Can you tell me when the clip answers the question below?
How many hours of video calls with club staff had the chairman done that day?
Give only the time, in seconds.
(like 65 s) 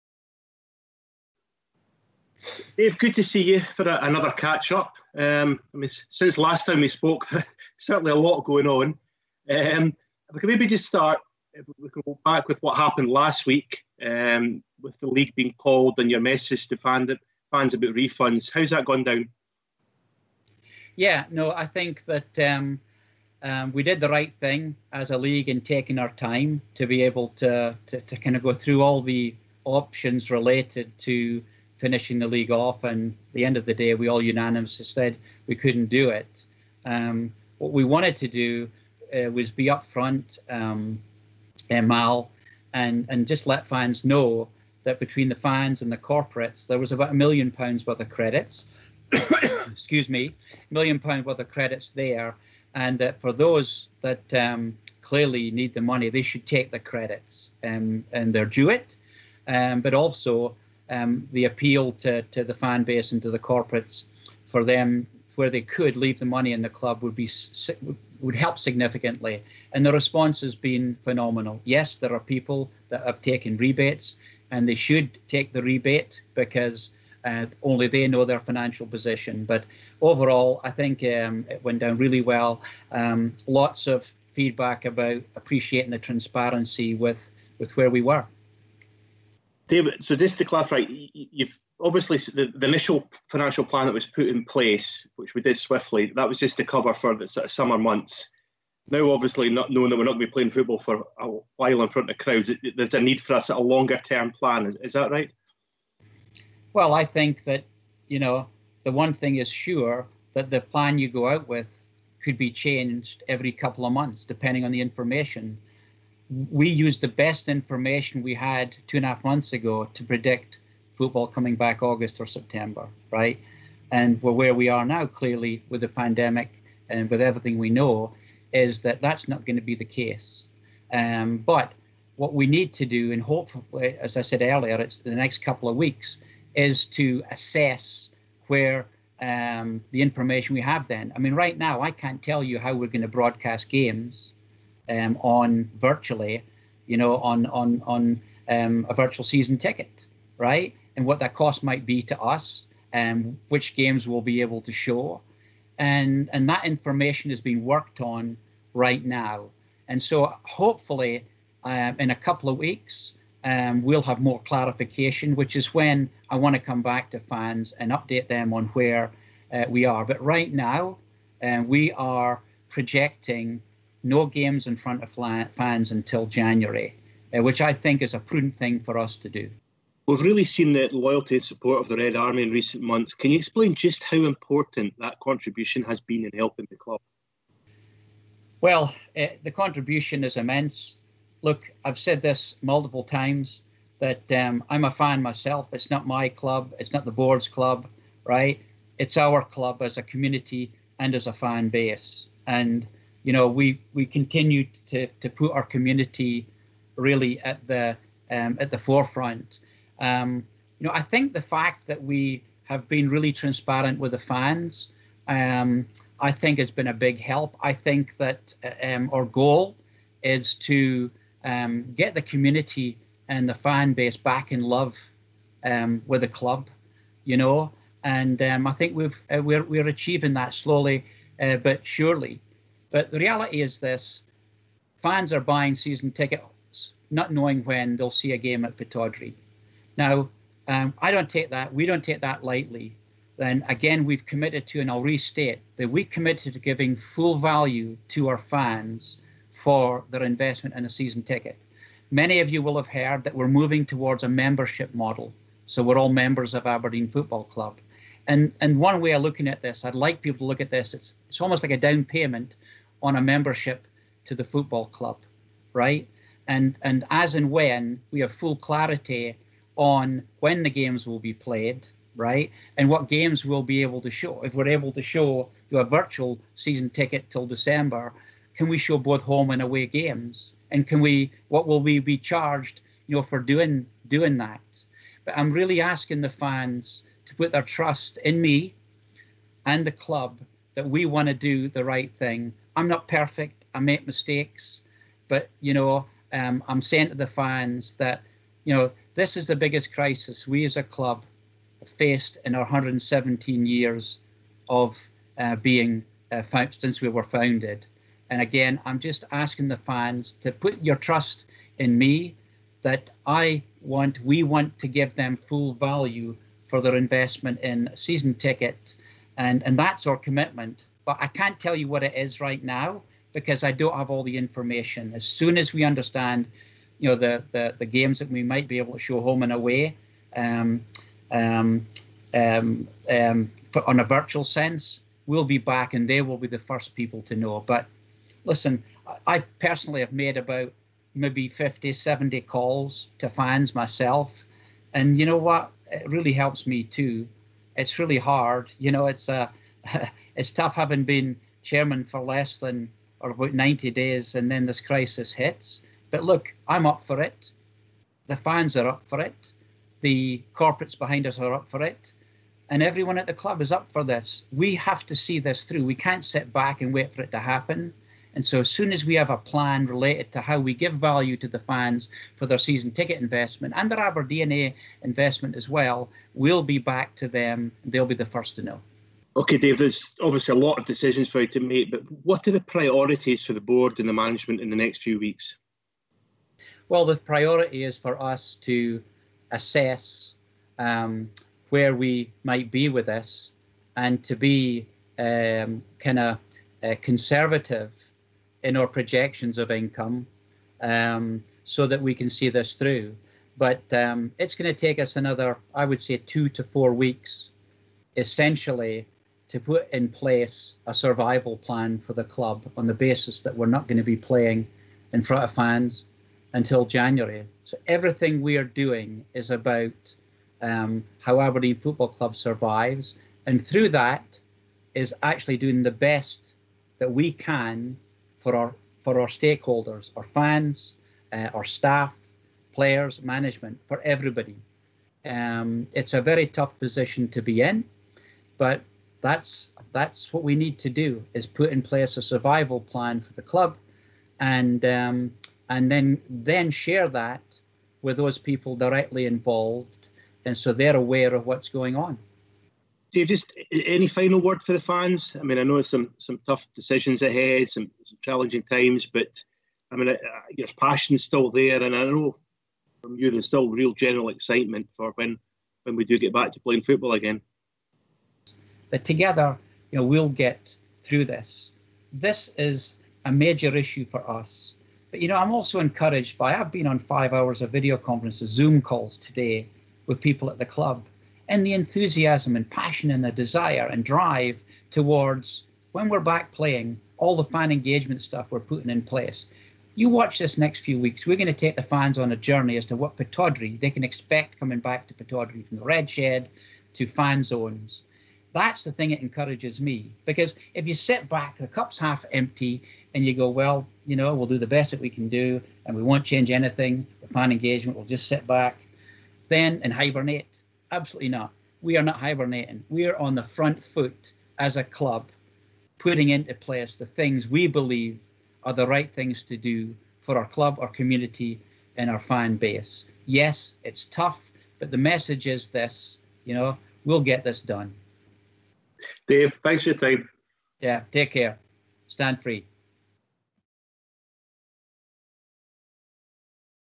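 476 s.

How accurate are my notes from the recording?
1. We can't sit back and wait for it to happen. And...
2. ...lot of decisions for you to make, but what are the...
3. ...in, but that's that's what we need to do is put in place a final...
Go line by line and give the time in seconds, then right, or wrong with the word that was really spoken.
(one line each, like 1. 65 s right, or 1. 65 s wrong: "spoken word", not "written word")
1. 365 s right
2. 380 s right
3. 437 s wrong: "survival", not "final".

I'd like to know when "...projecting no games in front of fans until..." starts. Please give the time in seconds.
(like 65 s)
172 s.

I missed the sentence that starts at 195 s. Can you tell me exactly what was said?
It's not my club, it's not the board's club, right?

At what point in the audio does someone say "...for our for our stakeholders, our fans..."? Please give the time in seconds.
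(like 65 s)
428 s.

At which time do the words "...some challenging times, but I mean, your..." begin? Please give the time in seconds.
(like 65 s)
458 s.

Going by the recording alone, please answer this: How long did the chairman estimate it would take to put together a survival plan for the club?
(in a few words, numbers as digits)
Two to four weeks.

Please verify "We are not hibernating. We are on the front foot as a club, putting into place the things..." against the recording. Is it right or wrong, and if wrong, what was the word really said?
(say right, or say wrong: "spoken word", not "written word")
right.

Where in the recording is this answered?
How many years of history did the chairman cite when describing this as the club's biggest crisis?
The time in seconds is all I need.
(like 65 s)
302 s.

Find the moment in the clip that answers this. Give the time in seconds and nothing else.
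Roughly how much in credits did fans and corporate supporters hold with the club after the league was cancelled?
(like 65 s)
50 s.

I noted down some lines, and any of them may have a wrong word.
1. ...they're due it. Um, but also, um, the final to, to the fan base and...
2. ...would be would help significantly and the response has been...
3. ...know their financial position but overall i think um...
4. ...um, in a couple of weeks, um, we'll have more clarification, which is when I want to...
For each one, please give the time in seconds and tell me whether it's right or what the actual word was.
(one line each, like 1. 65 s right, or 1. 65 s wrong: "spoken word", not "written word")
1. 58 s wrong: "appeal", not "final"
2. 67 s right
3. 78 s right
4. 161 s right.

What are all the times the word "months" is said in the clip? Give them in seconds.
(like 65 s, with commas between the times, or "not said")
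97 s, 113 s, 119 s, 182 s.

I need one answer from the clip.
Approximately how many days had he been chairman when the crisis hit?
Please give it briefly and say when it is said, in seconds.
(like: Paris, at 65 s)
90, at 353 s.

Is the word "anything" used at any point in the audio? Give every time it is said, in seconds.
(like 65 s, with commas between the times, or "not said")
506 s.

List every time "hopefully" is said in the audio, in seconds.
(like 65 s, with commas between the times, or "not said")
133 s, 160 s.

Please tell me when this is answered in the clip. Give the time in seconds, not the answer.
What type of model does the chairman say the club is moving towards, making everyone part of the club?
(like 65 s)
254 s.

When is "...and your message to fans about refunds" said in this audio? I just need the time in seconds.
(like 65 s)
15 s.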